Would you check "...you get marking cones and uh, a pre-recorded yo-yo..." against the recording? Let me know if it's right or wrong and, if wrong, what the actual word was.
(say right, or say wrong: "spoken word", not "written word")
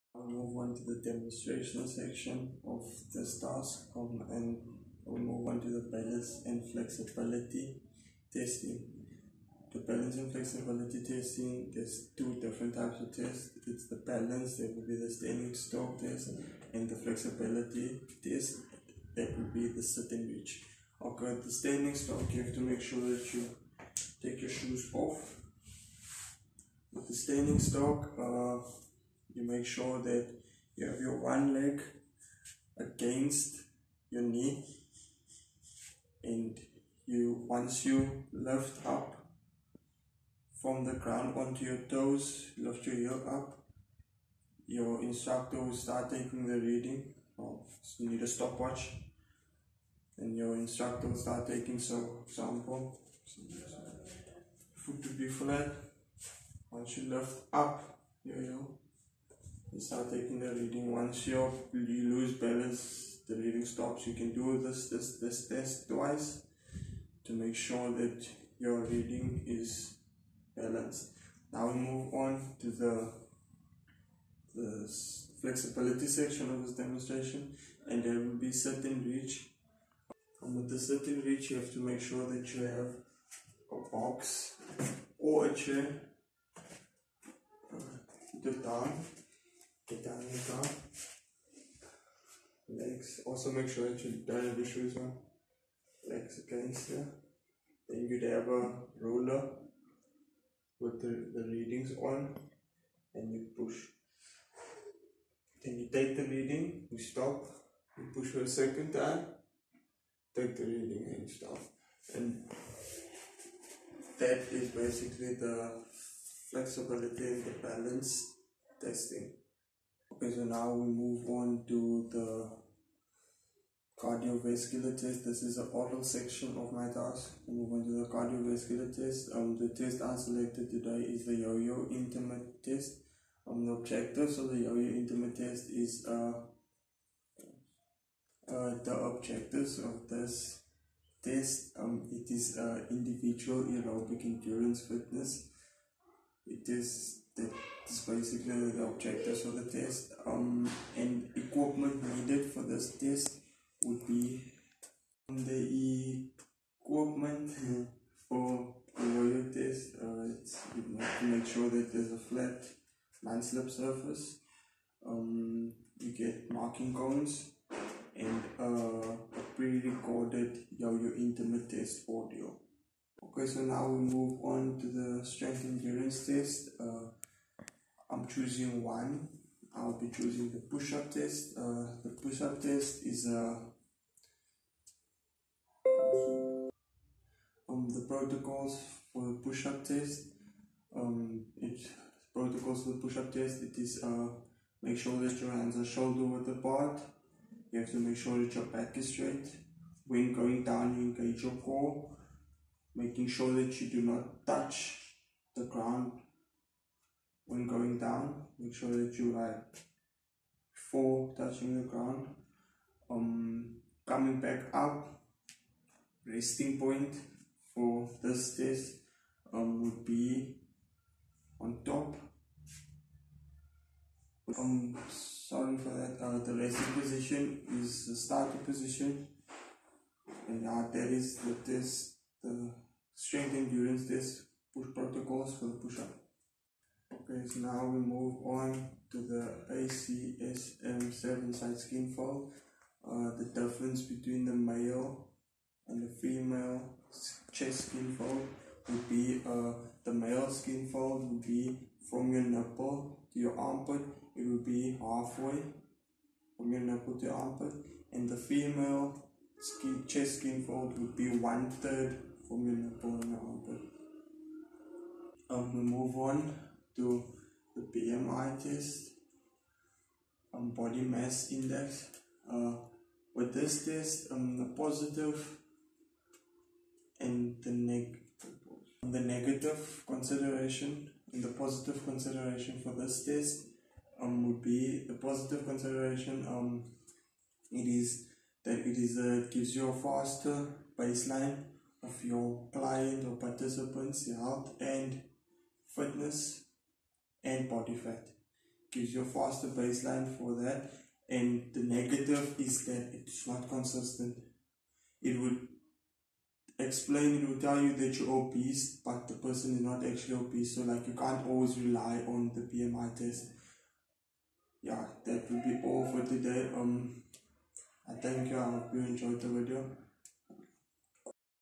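right.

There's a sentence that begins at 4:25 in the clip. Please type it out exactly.
Um, we move on to the BMI test, um, body mass index.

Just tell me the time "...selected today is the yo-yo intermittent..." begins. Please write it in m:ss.
2:10.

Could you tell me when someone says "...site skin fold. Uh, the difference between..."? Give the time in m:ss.
4:01.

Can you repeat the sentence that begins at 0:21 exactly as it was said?
Okay, the standing stork, you have to make sure that you take your shoes off.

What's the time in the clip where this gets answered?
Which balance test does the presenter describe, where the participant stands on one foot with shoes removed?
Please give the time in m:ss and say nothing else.
0:15.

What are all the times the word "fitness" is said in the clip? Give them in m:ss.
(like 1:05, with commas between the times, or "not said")
2:24, 4:55.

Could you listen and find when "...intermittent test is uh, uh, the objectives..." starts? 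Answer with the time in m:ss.
2:14.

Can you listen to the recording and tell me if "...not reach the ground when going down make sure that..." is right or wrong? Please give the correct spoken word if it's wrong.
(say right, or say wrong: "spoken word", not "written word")
wrong: "touch", not "reach".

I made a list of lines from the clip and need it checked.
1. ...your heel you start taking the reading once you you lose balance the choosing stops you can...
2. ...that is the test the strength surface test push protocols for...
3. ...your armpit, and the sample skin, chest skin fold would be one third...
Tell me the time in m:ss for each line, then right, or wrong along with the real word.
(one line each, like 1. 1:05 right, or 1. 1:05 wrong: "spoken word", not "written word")
1. 0:58 wrong: "reading", not "choosing"
2. 3:50 wrong: "endurance", not "surface"
3. 4:17 wrong: "female", not "sample".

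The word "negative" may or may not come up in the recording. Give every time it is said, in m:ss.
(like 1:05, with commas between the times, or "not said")
4:39, 5:01.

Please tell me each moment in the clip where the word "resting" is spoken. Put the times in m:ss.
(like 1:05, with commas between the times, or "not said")
3:36, 3:46.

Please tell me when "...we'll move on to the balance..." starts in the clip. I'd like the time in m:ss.
0:05.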